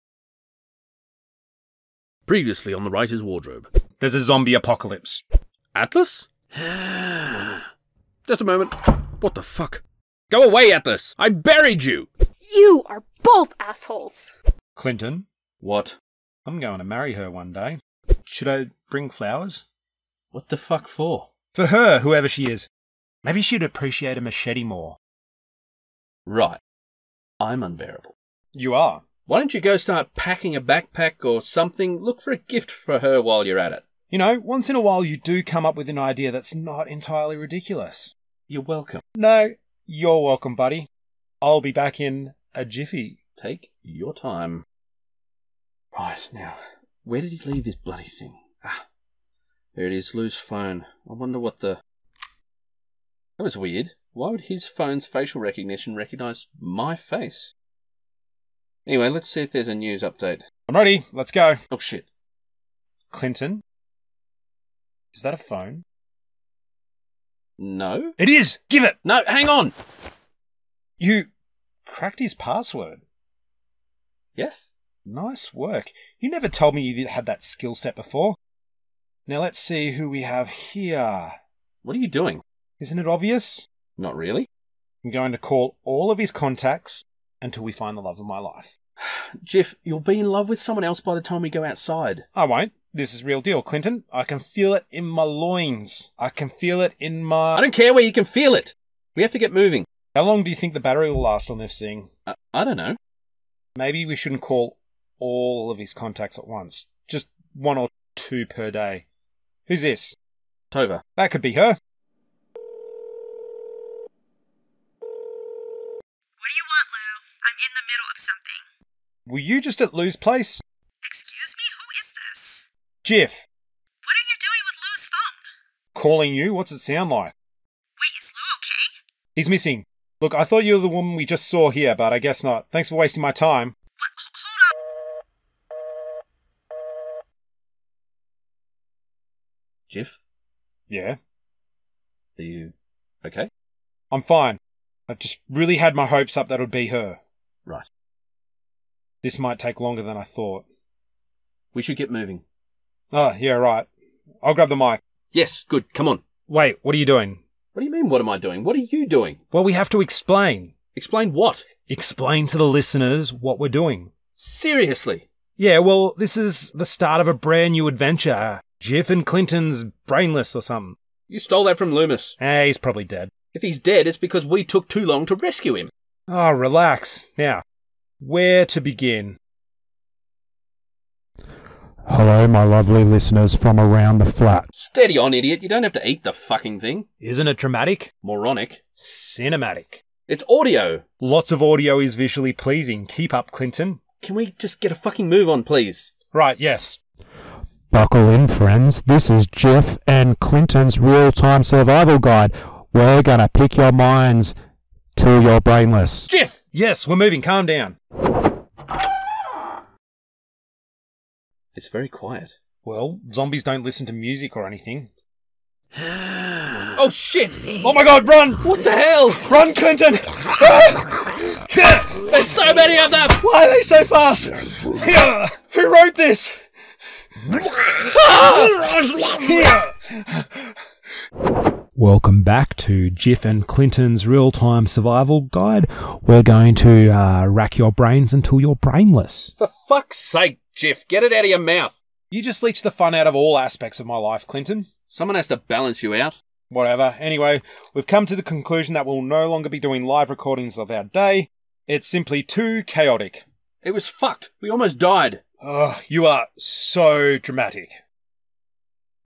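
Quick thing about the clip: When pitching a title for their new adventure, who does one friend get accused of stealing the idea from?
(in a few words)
Leumas.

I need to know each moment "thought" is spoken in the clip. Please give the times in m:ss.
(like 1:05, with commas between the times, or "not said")
2:10, 2:30.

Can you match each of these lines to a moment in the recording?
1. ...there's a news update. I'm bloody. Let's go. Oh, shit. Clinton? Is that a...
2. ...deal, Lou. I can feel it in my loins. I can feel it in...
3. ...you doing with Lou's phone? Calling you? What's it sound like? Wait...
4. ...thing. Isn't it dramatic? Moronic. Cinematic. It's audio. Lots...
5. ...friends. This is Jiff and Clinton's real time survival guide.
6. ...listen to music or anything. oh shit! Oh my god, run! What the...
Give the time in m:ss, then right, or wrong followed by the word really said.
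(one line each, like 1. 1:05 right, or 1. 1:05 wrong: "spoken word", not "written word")
1. 0:59 wrong: "ready", not "bloody"
2. 1:33 wrong: "Clinton", not "Lou"
3. 2:04 right
4. 3:06 right
5. 3:18 right
6. 3:33 right.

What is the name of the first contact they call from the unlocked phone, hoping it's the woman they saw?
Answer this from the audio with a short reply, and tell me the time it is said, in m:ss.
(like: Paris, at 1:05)
Tova, at 1:50.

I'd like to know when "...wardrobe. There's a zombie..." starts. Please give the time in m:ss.
0:03.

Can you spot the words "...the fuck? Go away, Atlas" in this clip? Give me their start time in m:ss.
0:09.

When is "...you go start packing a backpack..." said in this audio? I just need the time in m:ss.
0:29.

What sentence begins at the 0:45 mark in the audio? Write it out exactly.
Right, now, where did he leave this bloody thing?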